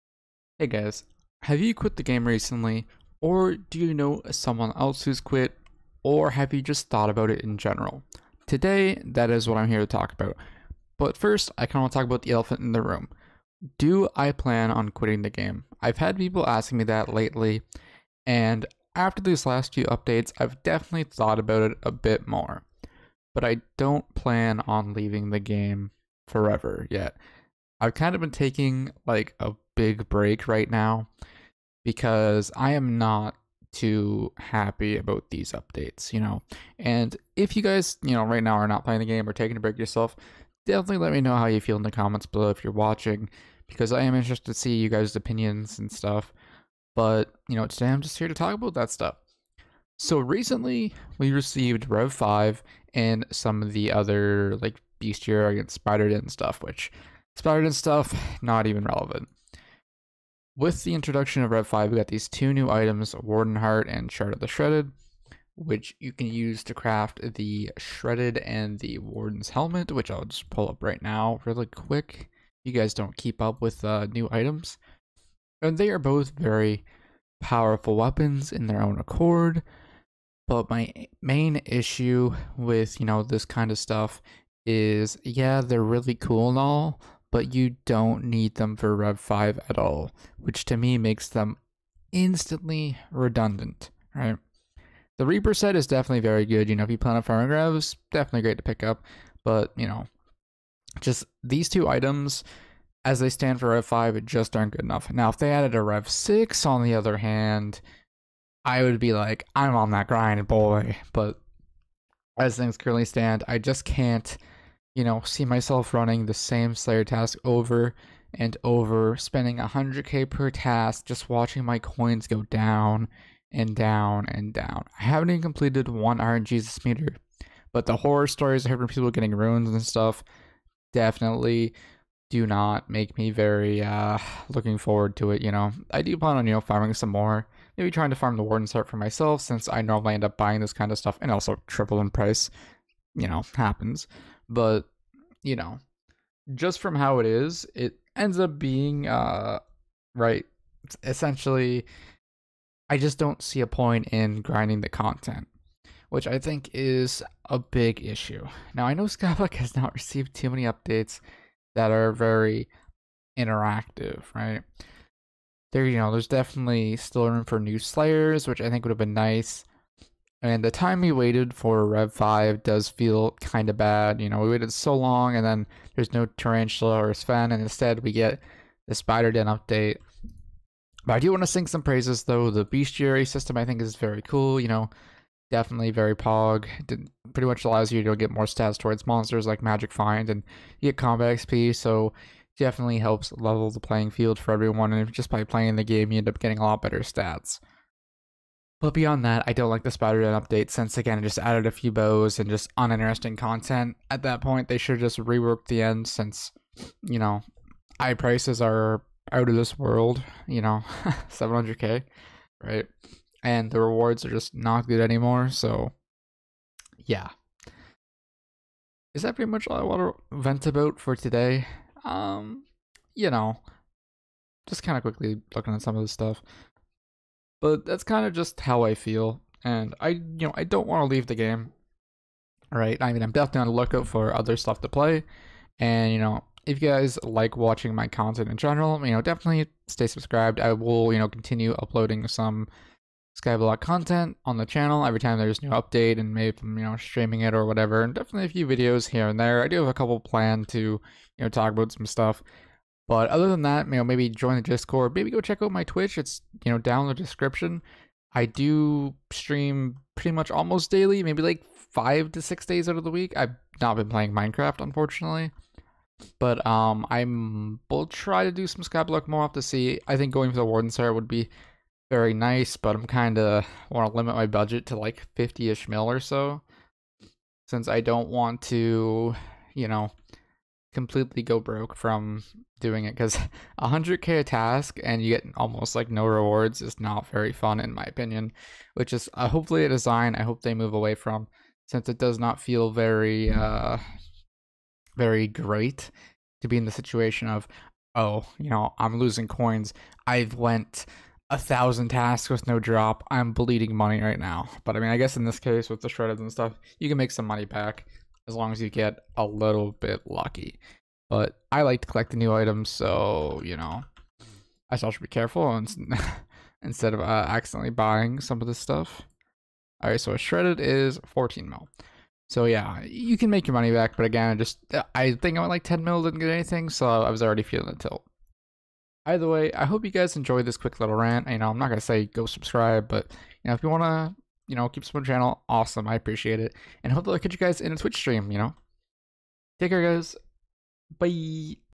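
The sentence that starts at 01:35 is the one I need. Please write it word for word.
The Reaper set is definitely very good.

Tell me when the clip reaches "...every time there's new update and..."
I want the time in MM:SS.
04:05.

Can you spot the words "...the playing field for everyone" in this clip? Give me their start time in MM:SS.
03:13.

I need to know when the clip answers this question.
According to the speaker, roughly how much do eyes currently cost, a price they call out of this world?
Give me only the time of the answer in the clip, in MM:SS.
03:31.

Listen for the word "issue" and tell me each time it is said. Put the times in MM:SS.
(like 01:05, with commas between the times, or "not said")
01:21, 02:38.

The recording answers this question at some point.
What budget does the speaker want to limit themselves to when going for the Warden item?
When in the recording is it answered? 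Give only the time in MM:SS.
04:35.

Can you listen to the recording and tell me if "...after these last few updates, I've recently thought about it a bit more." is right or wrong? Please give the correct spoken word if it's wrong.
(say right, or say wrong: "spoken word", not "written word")
wrong: "definitely", not "recently".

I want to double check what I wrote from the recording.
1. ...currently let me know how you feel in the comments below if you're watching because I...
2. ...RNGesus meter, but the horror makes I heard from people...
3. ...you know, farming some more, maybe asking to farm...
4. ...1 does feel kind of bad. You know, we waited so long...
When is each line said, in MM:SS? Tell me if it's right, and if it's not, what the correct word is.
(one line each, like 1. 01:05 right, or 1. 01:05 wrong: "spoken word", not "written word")
1. 00:40 wrong: "definitely", not "currently"
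2. 02:06 wrong: "stories", not "makes"
3. 02:16 wrong: "trying", not "asking"
4. 02:52 wrong: "5", not "1".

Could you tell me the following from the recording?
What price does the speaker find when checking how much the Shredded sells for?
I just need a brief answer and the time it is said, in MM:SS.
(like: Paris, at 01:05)
14 mil, at 05:21.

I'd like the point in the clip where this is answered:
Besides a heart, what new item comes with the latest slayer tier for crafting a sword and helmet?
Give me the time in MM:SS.
01:04.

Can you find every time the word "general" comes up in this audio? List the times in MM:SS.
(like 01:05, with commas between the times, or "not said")
00:07, 03:58.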